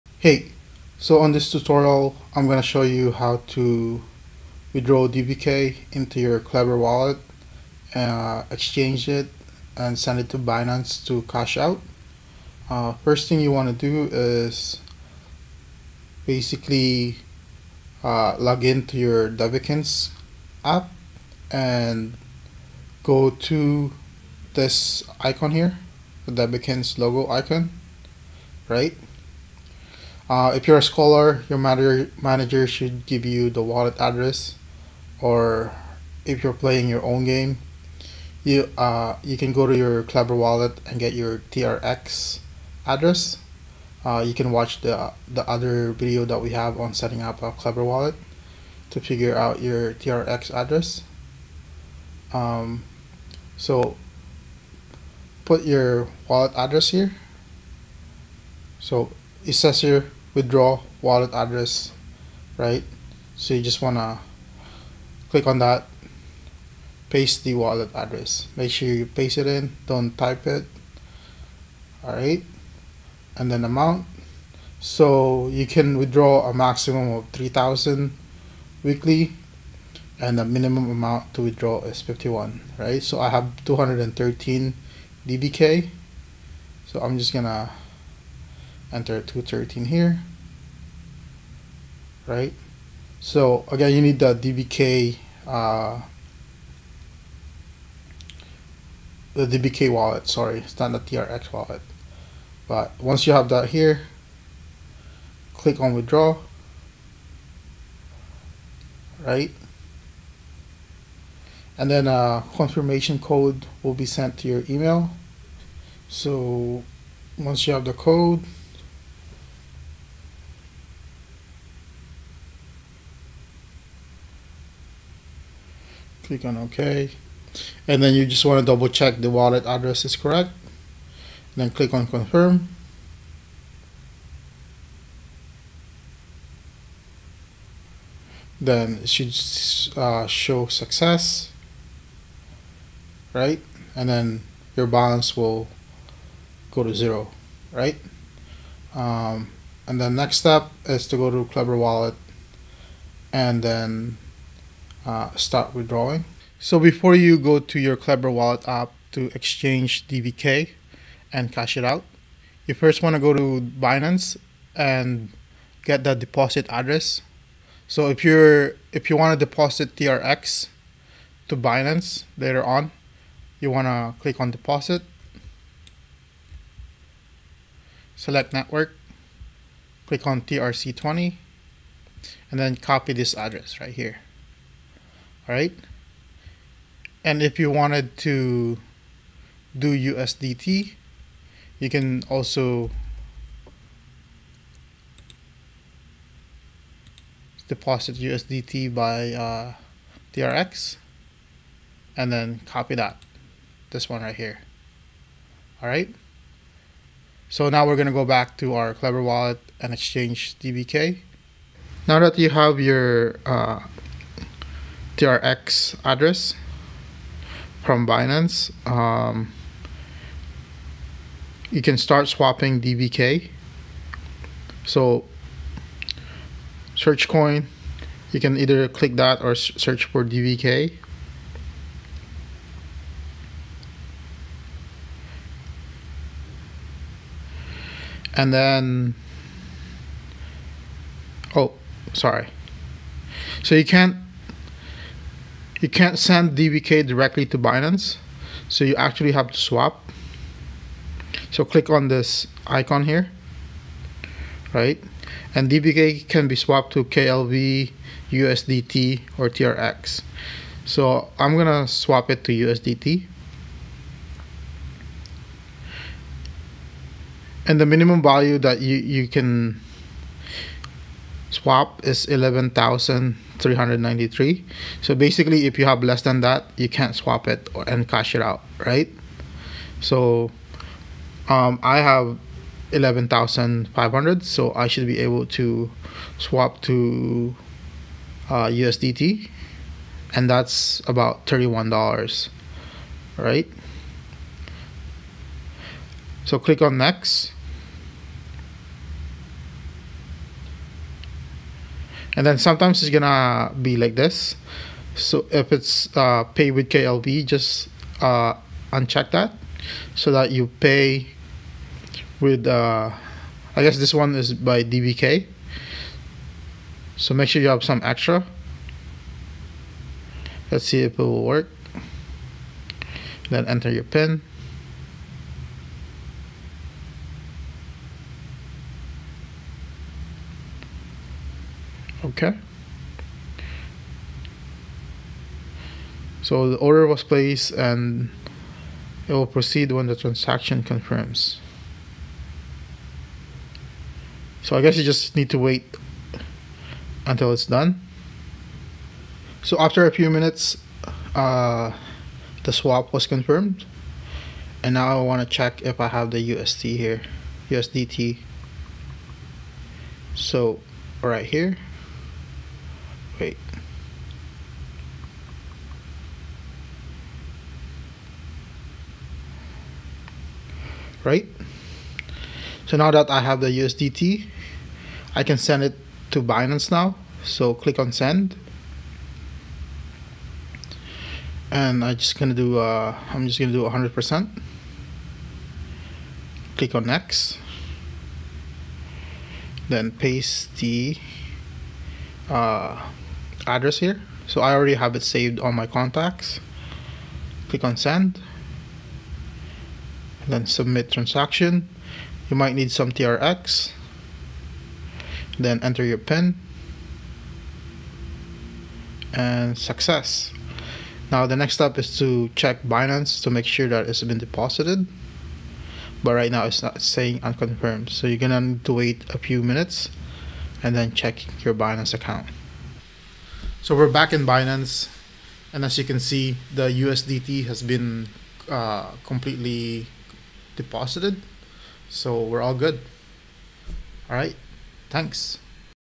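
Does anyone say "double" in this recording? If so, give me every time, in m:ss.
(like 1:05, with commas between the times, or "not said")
2:08.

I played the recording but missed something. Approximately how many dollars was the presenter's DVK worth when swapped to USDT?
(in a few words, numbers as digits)
$31.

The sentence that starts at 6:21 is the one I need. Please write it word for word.
And I just gonna do uh, I'm just gonna do 100%.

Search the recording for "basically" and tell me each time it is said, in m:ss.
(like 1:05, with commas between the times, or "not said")
0:16, 4:35.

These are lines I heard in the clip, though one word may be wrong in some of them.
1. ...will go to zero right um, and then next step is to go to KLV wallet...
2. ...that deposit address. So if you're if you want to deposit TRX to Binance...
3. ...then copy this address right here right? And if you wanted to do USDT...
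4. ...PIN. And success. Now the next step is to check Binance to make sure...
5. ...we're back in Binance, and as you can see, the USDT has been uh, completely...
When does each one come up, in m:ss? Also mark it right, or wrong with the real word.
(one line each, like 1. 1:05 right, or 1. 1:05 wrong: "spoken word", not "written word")
1. 2:25 wrong: "Klever", not "KLV"
2. 2:46 right
3. 3:02 right
4. 6:46 right
5. 7:03 right.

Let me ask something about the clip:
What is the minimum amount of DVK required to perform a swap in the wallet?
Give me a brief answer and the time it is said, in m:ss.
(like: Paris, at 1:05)
11,393, at 4:32.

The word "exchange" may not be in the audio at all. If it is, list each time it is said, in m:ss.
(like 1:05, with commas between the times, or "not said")
0:08, 2:39, 3:29.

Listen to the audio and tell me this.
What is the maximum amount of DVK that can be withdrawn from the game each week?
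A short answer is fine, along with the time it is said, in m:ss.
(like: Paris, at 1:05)
3000, at 1:17.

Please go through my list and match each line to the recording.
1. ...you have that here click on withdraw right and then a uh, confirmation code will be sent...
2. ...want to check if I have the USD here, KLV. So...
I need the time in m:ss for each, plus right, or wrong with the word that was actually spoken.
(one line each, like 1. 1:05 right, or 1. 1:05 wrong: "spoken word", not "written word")
1. 1:43 right
2. 5:55 wrong: "USDT", not "KLV".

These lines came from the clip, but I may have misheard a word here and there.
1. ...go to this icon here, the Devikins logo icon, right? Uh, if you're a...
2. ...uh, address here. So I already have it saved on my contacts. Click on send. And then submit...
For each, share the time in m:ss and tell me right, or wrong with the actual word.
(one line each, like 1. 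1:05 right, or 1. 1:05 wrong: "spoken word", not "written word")
1. 0:23 right
2. 6:32 right.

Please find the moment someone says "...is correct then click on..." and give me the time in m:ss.
2:10.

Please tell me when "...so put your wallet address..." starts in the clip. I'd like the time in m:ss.
0:53.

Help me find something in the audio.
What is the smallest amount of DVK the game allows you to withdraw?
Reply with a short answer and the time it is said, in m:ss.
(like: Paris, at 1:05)
51, at 1:22.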